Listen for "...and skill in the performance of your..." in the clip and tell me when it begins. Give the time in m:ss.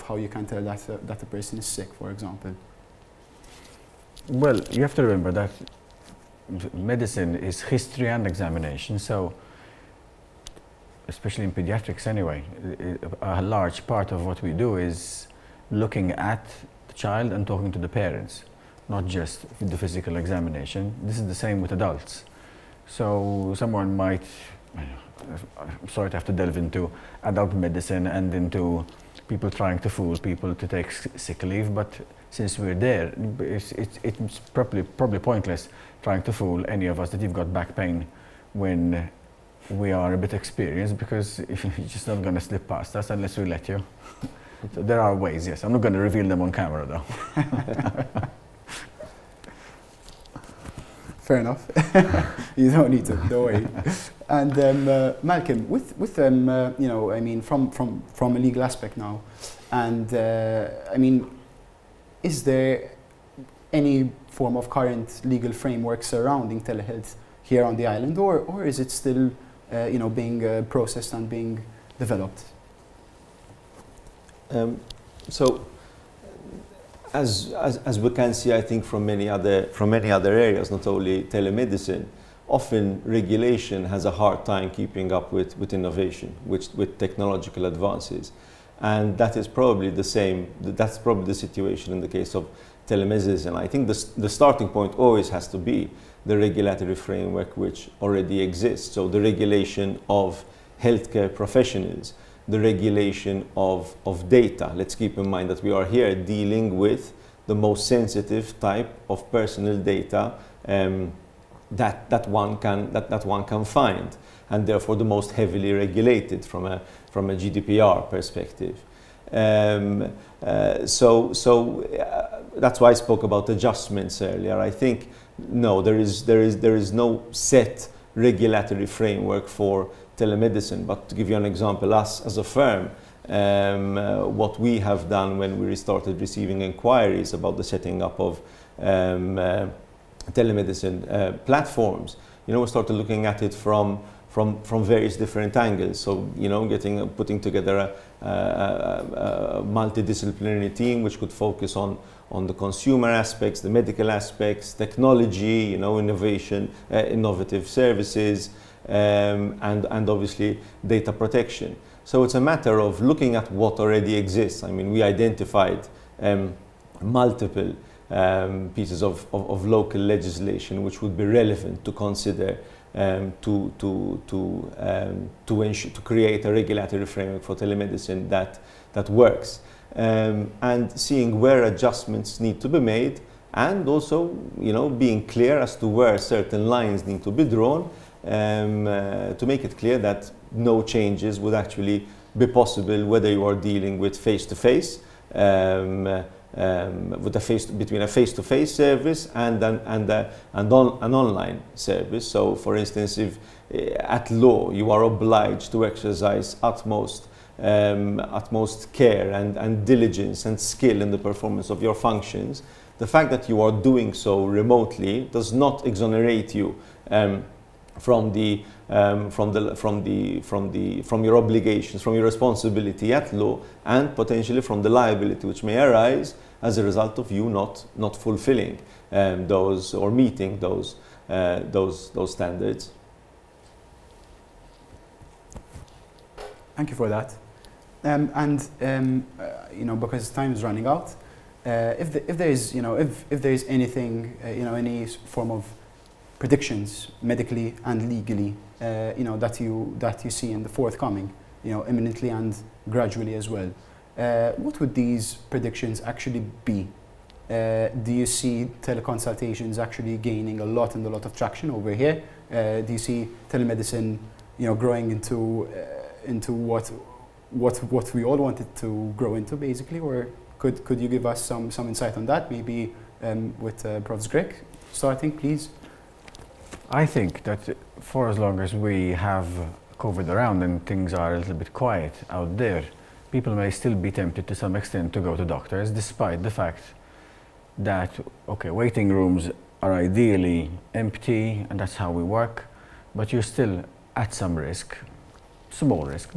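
3:30.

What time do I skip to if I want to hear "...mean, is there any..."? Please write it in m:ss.
1:00.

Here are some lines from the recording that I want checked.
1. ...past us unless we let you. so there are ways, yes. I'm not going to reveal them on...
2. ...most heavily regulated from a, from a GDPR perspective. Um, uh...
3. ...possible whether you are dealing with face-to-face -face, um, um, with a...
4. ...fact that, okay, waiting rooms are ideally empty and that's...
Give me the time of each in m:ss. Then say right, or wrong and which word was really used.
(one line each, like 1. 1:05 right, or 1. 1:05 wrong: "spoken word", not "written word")
1. 0:42 right
2. 1:55 right
3. 3:12 right
4. 4:46 right.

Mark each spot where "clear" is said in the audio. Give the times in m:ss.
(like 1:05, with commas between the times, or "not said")
3:05, 3:09.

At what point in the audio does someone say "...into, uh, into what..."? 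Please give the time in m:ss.
4:25.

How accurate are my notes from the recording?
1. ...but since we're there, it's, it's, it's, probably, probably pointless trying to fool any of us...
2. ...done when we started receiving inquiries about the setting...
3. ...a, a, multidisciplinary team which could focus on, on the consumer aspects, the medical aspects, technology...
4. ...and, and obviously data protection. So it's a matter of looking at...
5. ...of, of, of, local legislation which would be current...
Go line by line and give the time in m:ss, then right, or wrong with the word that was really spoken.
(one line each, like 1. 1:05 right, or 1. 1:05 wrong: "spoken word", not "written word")
1. 0:31 right
2. 2:15 right
3. 2:28 right
4. 2:39 right
5. 2:49 wrong: "relevant", not "current".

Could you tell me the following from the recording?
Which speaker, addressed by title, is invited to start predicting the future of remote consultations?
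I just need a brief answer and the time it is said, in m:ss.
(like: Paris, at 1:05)
Profs Grech, at 4:34.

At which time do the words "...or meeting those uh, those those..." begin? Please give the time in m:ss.
3:49.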